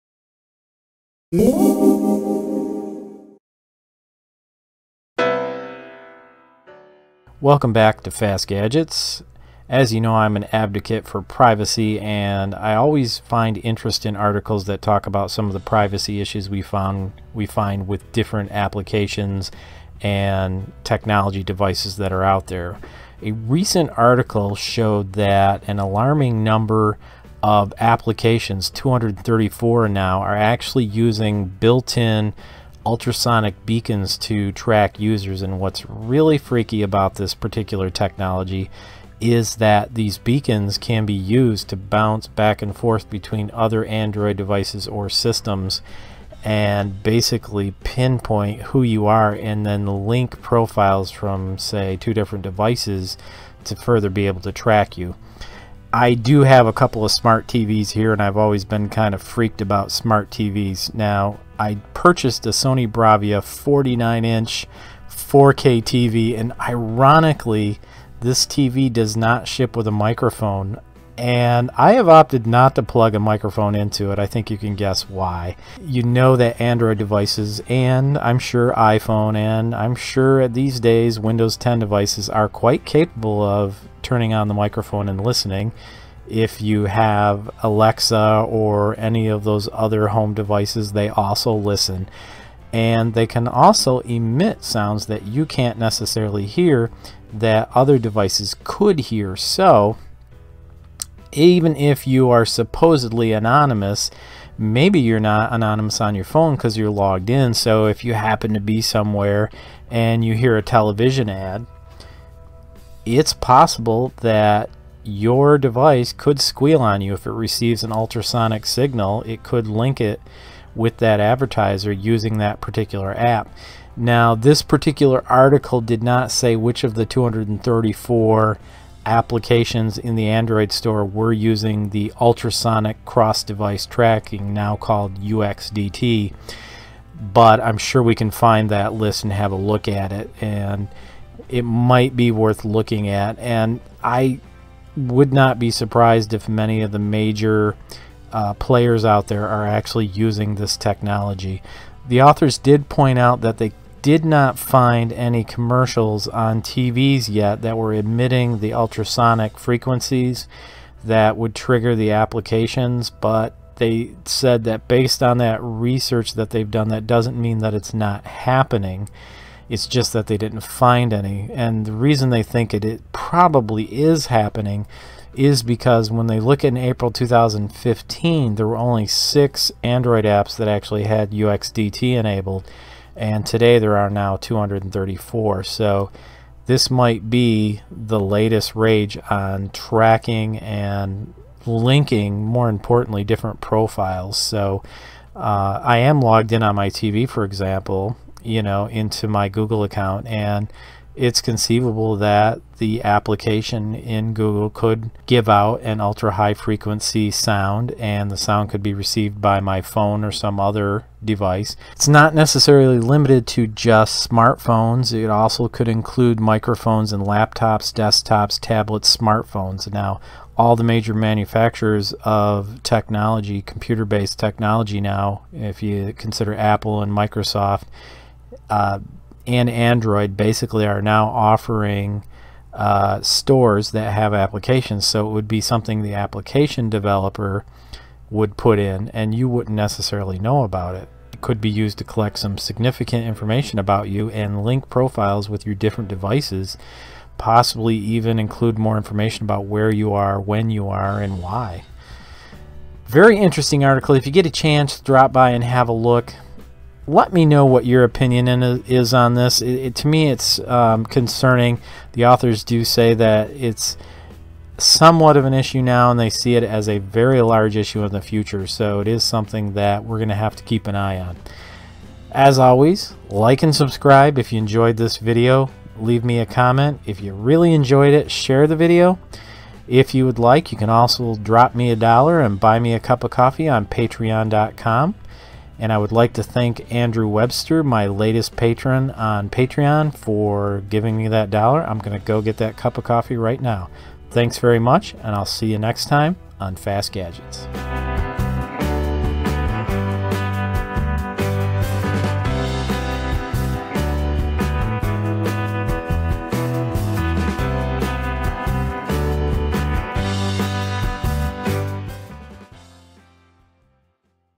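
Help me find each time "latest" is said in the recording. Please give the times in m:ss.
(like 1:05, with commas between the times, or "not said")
3:08, 4:48.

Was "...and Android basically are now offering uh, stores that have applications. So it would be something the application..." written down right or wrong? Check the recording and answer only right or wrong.
right.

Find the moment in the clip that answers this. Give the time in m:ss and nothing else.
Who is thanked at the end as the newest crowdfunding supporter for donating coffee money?
4:46.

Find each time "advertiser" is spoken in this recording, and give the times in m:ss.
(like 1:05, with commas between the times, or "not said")
2:01.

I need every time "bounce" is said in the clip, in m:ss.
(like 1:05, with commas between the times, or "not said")
0:41.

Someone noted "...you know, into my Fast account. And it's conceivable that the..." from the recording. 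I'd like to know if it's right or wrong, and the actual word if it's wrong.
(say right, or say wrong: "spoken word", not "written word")
wrong: "Google", not "Fast".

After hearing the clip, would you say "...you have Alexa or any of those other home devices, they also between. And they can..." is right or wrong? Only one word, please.
wrong.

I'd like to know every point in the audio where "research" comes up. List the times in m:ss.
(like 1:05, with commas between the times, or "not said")
2:45.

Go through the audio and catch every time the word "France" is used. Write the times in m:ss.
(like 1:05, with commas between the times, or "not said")
not said.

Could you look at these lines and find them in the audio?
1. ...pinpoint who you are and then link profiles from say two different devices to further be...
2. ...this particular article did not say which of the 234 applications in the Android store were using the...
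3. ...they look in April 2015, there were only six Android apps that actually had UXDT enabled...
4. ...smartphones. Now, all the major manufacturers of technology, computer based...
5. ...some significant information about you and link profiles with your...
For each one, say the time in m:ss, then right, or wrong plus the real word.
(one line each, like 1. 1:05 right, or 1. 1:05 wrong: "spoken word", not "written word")
1. 0:47 right
2. 2:04 right
3. 2:56 right
4. 3:39 right
5. 4:02 right.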